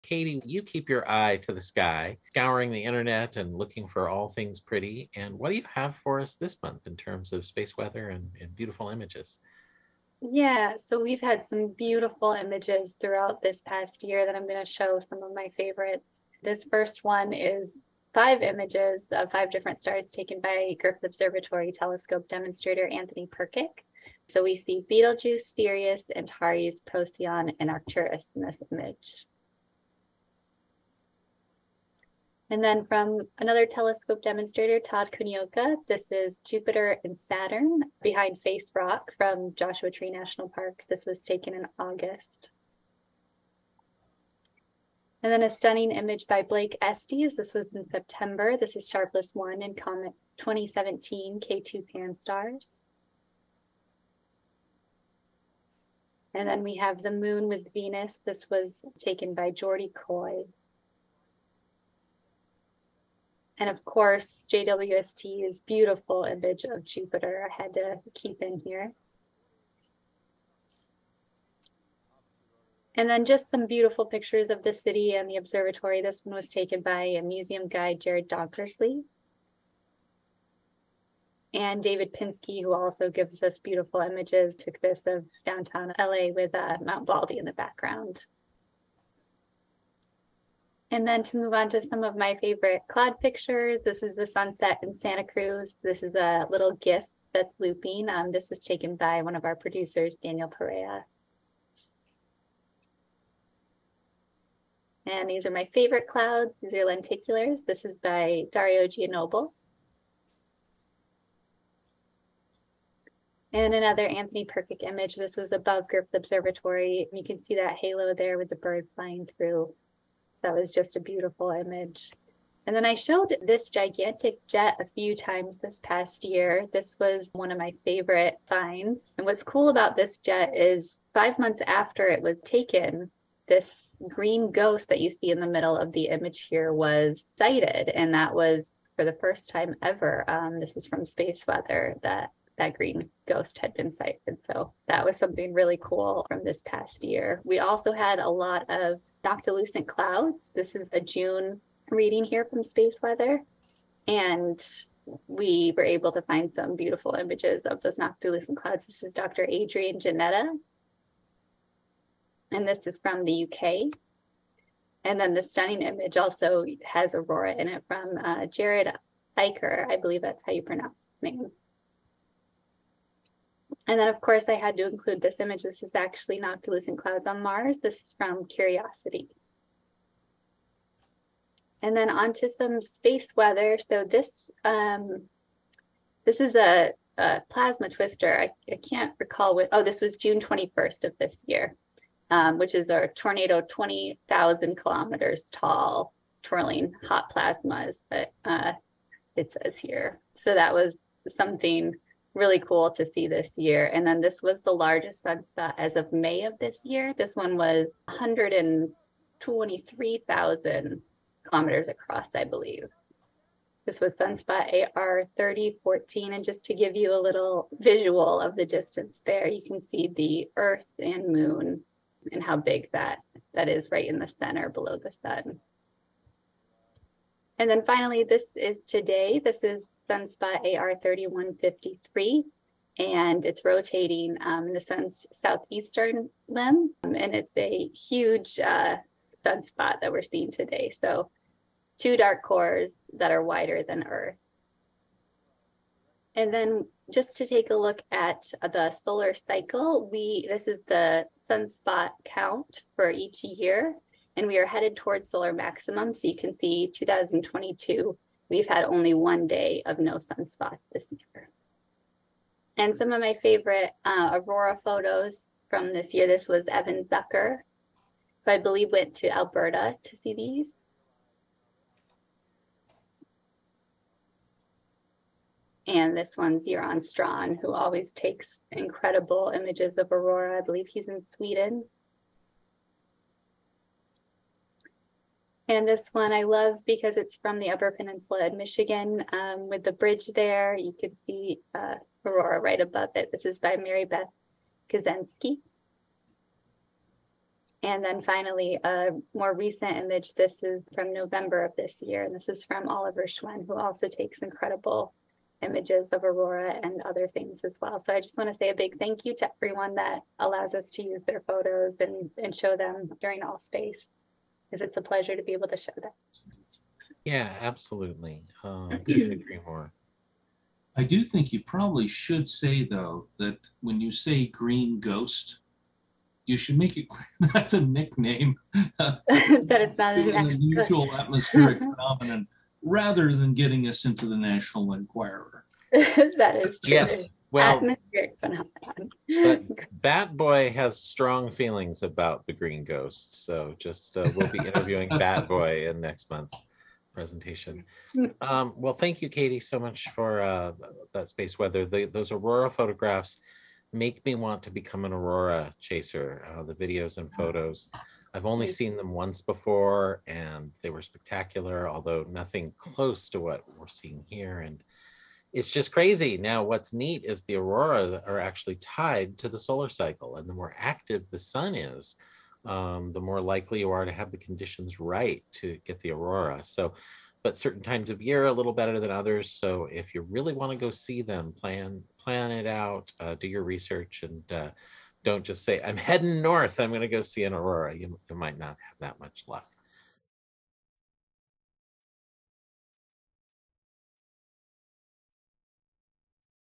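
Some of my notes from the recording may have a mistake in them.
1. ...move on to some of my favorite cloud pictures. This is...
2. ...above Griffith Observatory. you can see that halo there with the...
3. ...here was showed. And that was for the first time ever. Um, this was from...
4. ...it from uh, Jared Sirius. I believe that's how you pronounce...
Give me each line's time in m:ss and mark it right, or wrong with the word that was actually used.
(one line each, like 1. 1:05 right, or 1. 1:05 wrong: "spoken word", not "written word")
1. 1:31 right
2. 1:55 right
3. 2:16 wrong: "sighted", not "showed"
4. 2:47 wrong: "Eicher", not "Sirius".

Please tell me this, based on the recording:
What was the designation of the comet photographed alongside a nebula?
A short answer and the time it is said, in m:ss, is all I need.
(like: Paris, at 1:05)
2017 K2 PANSTARRS, at 0:50.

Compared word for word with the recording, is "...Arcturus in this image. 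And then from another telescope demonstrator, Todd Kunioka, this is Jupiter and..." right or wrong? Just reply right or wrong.
right.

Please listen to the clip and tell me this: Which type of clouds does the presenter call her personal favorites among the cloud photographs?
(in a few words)
Lenticulars.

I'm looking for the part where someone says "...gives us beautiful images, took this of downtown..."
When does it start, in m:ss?
1:23.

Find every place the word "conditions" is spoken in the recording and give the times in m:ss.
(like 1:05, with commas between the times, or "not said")
6:14.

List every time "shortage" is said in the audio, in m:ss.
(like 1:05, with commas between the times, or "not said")
not said.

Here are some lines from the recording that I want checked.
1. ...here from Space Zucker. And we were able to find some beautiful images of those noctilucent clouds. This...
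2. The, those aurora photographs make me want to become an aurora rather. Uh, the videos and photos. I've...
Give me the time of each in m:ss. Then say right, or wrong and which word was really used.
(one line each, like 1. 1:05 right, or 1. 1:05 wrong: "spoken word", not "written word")
1. 2:32 wrong: "Weather", not "Zucker"
2. 5:51 wrong: "chaser", not "rather".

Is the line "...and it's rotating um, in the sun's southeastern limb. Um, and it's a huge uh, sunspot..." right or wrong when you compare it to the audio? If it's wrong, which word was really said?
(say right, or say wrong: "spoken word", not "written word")
right.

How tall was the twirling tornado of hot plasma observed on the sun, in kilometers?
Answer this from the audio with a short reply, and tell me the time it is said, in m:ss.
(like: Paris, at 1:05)
20,000 kilometers, at 3:13.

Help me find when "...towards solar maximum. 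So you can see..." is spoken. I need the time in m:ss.
4:14.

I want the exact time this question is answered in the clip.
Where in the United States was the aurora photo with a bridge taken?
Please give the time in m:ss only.
4:47.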